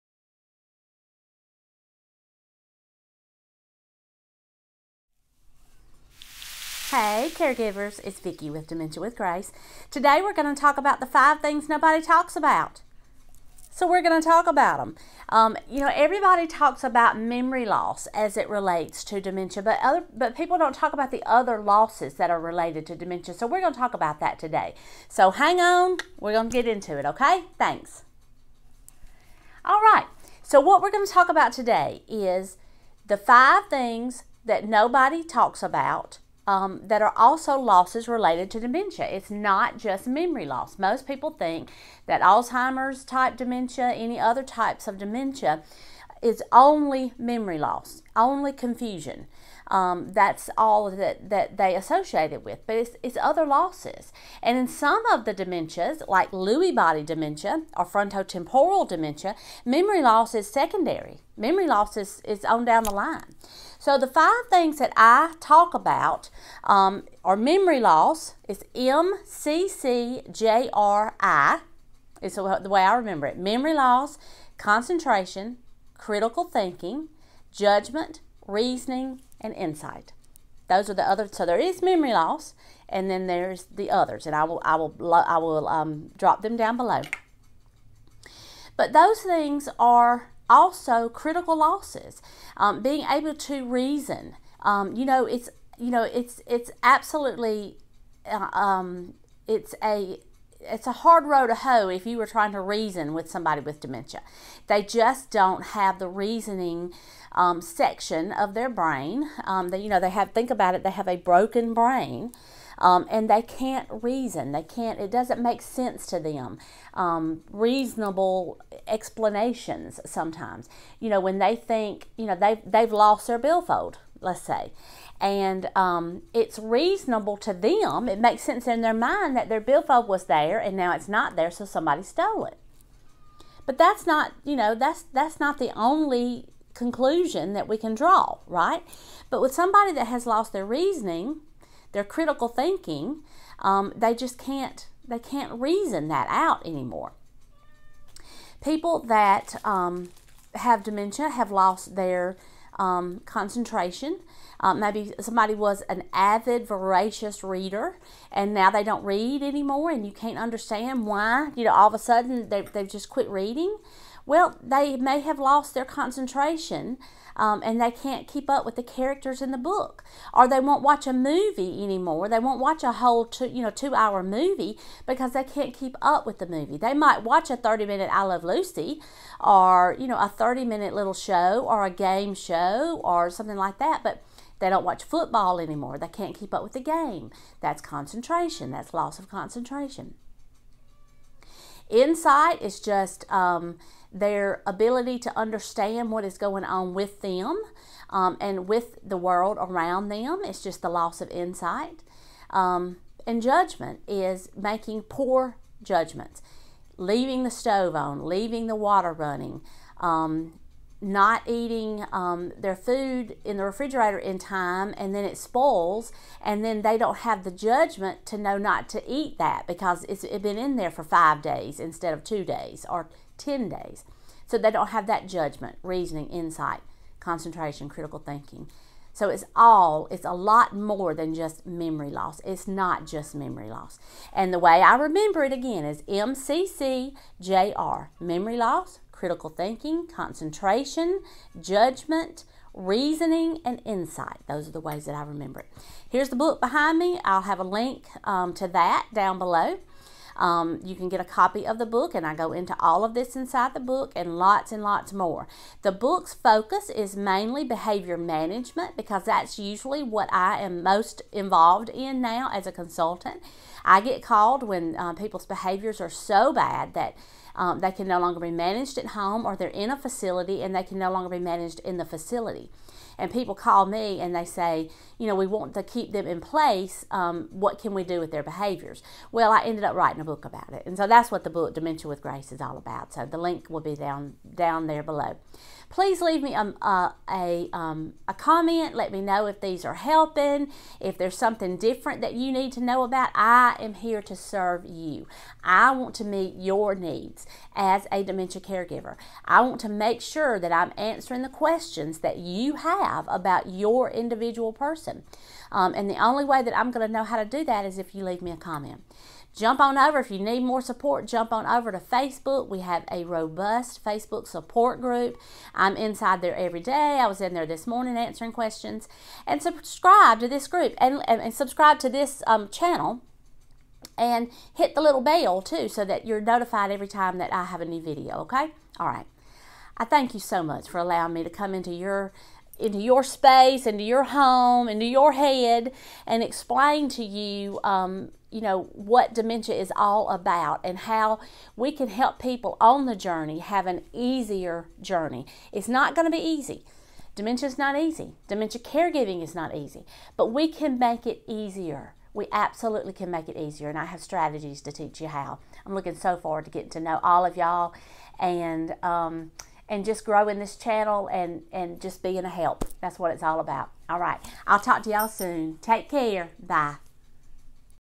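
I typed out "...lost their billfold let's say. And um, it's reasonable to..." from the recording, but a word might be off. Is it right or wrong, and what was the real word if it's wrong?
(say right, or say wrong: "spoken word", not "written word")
right.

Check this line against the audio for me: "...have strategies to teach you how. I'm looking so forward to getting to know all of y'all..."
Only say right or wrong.
right.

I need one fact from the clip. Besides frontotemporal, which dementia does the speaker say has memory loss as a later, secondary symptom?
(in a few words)
Lewy body dementia.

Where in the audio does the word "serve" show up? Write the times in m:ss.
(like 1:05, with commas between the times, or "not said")
4:54.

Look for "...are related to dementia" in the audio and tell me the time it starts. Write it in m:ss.
0:22.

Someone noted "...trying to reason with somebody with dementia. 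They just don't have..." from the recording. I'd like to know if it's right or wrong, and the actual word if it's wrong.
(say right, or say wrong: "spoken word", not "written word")
right.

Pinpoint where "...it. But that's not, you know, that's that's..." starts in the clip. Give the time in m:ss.
2:12.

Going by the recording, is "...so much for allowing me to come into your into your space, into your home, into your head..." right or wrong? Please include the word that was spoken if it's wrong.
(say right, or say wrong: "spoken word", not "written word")
right.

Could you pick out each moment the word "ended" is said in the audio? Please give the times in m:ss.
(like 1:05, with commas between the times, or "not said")
4:39.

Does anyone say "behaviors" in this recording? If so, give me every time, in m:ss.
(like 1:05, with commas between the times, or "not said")
4:17, 4:25, 4:38.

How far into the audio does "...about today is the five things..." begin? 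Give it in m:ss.
0:31.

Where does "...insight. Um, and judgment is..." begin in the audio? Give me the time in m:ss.
3:21.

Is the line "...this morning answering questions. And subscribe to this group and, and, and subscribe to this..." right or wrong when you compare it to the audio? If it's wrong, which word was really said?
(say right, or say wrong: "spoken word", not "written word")
right.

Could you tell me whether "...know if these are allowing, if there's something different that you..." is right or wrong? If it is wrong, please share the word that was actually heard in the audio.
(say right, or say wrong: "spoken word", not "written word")
wrong: "helping", not "allowing".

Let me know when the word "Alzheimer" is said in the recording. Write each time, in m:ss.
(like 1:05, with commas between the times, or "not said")
0:42.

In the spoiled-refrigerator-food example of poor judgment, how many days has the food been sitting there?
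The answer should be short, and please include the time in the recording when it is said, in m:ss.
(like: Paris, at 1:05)
5, at 3:41.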